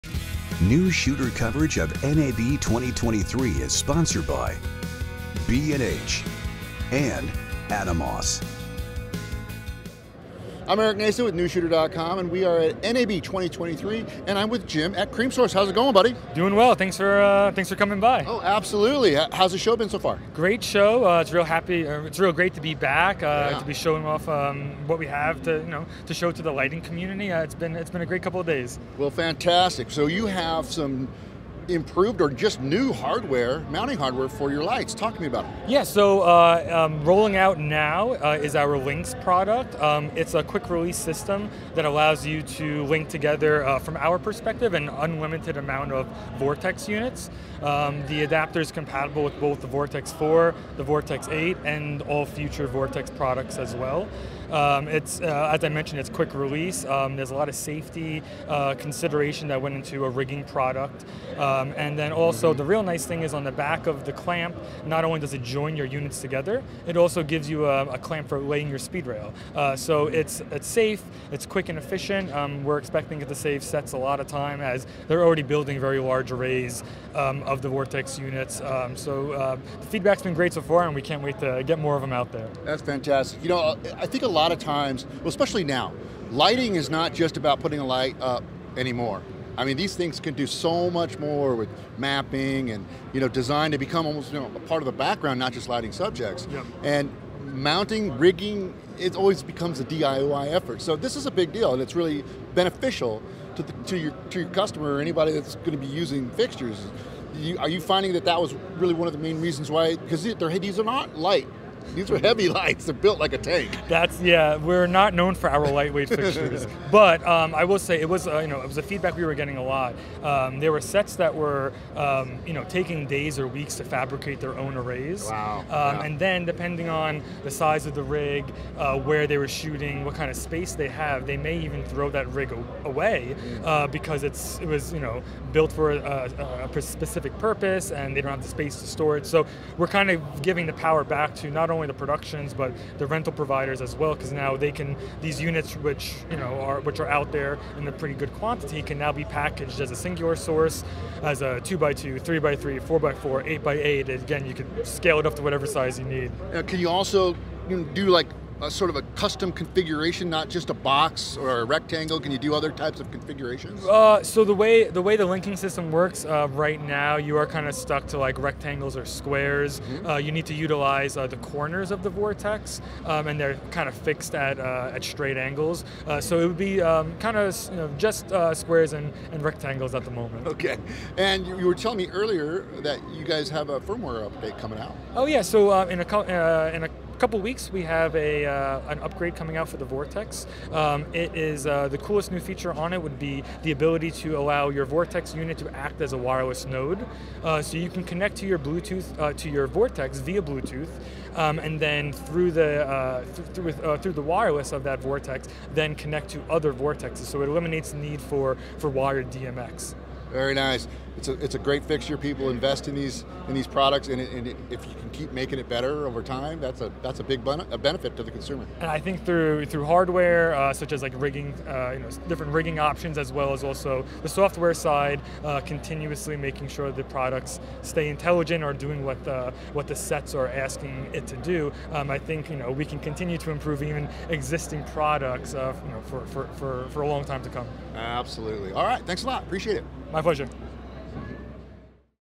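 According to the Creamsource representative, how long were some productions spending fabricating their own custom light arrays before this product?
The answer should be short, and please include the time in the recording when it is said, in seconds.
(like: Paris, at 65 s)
Days or weeks, at 123 s.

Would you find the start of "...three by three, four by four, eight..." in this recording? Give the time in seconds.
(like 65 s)
152 s.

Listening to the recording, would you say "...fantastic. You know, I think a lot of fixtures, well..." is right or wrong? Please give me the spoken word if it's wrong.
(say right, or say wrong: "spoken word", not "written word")
wrong: "times", not "fixtures".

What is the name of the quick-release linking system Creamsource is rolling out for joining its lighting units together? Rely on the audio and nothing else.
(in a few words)
LNX.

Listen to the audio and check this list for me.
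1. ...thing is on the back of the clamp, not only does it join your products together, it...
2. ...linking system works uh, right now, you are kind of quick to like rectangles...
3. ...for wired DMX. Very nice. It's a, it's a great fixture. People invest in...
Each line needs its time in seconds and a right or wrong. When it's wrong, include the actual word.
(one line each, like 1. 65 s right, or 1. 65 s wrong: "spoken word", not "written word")
1. 63 s wrong: "units", not "products"
2. 165 s wrong: "stuck", not "quick"
3. 208 s right.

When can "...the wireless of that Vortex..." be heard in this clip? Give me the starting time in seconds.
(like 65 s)
204 s.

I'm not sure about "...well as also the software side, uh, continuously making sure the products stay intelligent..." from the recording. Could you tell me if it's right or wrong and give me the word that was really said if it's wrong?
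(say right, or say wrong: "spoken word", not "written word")
right.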